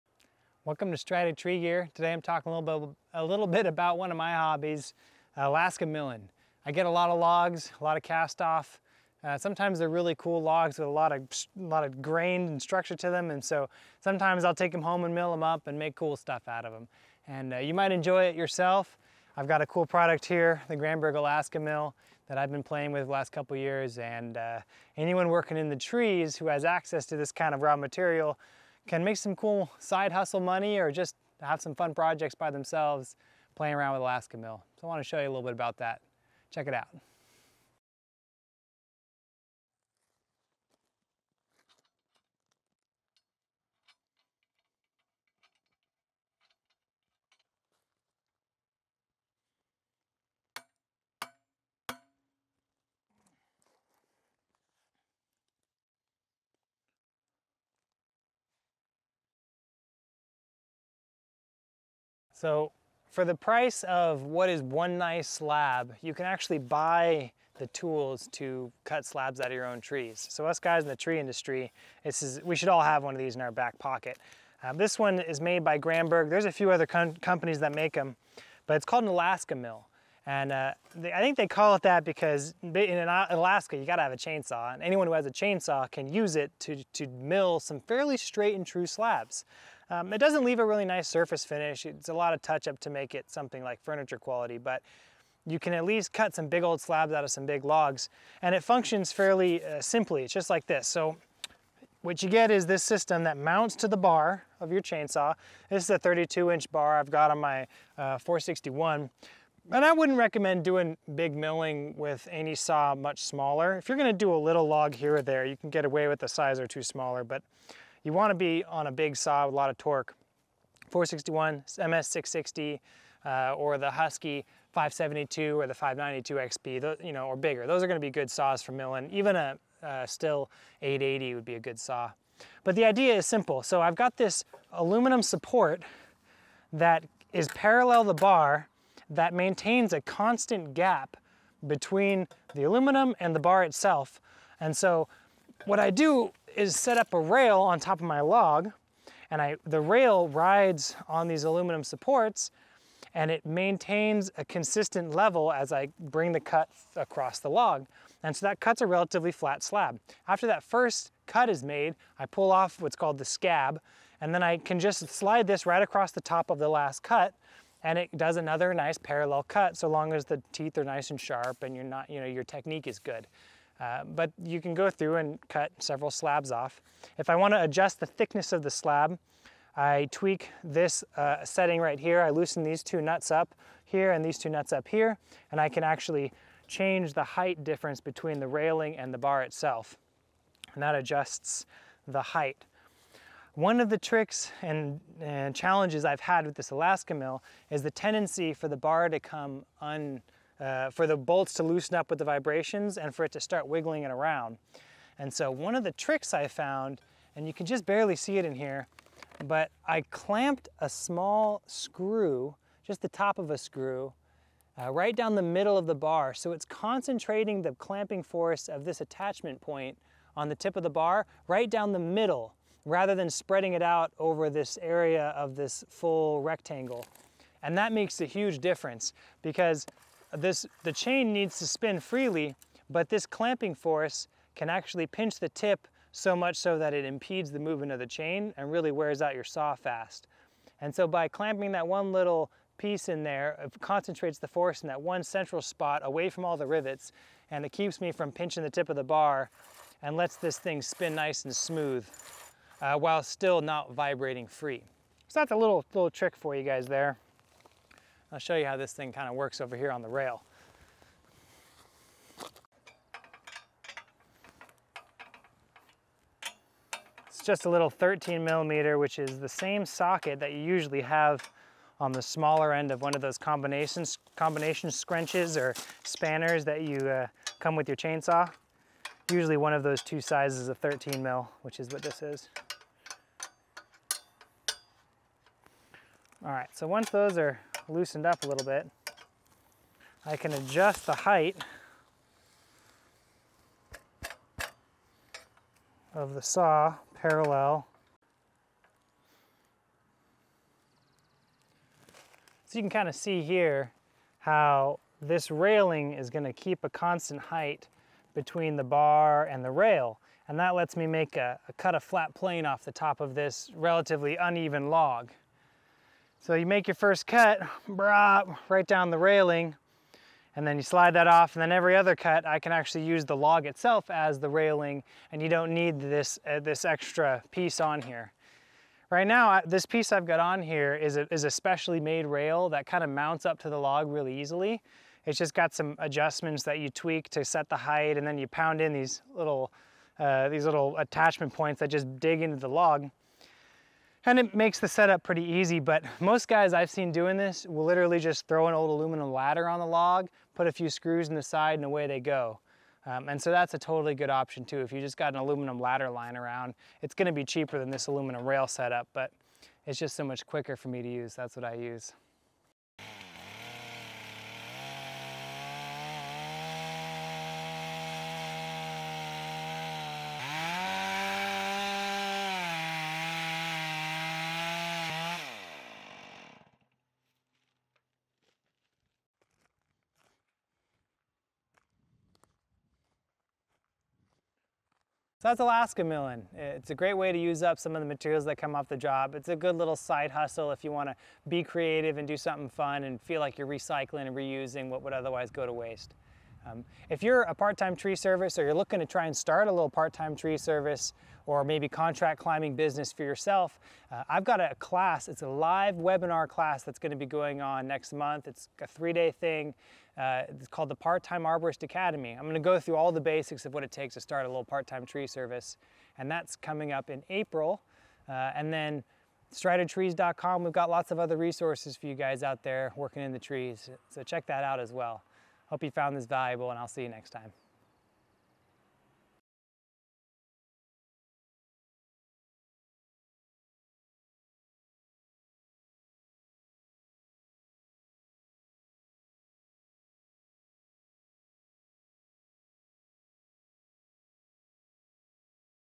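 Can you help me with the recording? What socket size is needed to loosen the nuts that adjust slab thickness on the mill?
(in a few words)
13 millimeter.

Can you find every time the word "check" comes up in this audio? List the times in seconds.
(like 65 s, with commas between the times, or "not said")
36 s, 424 s.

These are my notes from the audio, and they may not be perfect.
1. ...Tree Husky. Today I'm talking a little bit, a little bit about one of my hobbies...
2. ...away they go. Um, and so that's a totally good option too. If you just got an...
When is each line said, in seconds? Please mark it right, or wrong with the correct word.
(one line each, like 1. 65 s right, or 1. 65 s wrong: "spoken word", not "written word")
1. 1 s wrong: "Gear", not "Husky"
2. 351 s right.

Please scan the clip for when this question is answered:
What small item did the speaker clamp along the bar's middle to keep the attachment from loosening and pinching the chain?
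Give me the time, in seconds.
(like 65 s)
213 s.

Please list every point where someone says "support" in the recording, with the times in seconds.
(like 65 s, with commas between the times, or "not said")
135 s, 151 s.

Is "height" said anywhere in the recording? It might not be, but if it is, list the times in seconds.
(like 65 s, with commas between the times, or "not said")
187 s, 192 s, 291 s, 307 s, 337 s.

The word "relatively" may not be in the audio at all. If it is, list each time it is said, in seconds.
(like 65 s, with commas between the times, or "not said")
158 s, 313 s.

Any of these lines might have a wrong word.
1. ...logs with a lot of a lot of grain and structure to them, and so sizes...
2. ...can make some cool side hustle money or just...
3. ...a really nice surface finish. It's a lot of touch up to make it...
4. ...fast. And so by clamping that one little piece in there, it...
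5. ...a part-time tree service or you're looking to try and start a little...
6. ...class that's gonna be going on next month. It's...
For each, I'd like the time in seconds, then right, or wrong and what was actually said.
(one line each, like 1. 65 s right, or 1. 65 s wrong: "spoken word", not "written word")
1. 10 s wrong: "sometimes", not "sizes"
2. 28 s right
3. 90 s right
4. 239 s right
5. 397 s right
6. 406 s right.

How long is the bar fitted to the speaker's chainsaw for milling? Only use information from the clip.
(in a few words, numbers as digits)
32 inch.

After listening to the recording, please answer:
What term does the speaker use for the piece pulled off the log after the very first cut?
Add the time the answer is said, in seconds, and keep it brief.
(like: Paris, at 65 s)
scab, at 163 s.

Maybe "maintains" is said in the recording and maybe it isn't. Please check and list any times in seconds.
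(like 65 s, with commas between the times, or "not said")
139 s, 153 s.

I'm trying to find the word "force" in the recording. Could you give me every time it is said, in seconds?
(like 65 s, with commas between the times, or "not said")
218 s, 233 s, 244 s.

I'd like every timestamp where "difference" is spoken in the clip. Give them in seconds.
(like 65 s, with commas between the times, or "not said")
187 s, 228 s.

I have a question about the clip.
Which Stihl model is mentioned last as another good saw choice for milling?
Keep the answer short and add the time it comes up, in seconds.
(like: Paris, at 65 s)
Stihl 880, at 130 s.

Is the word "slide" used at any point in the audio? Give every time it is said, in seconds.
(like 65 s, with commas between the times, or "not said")
165 s, 320 s.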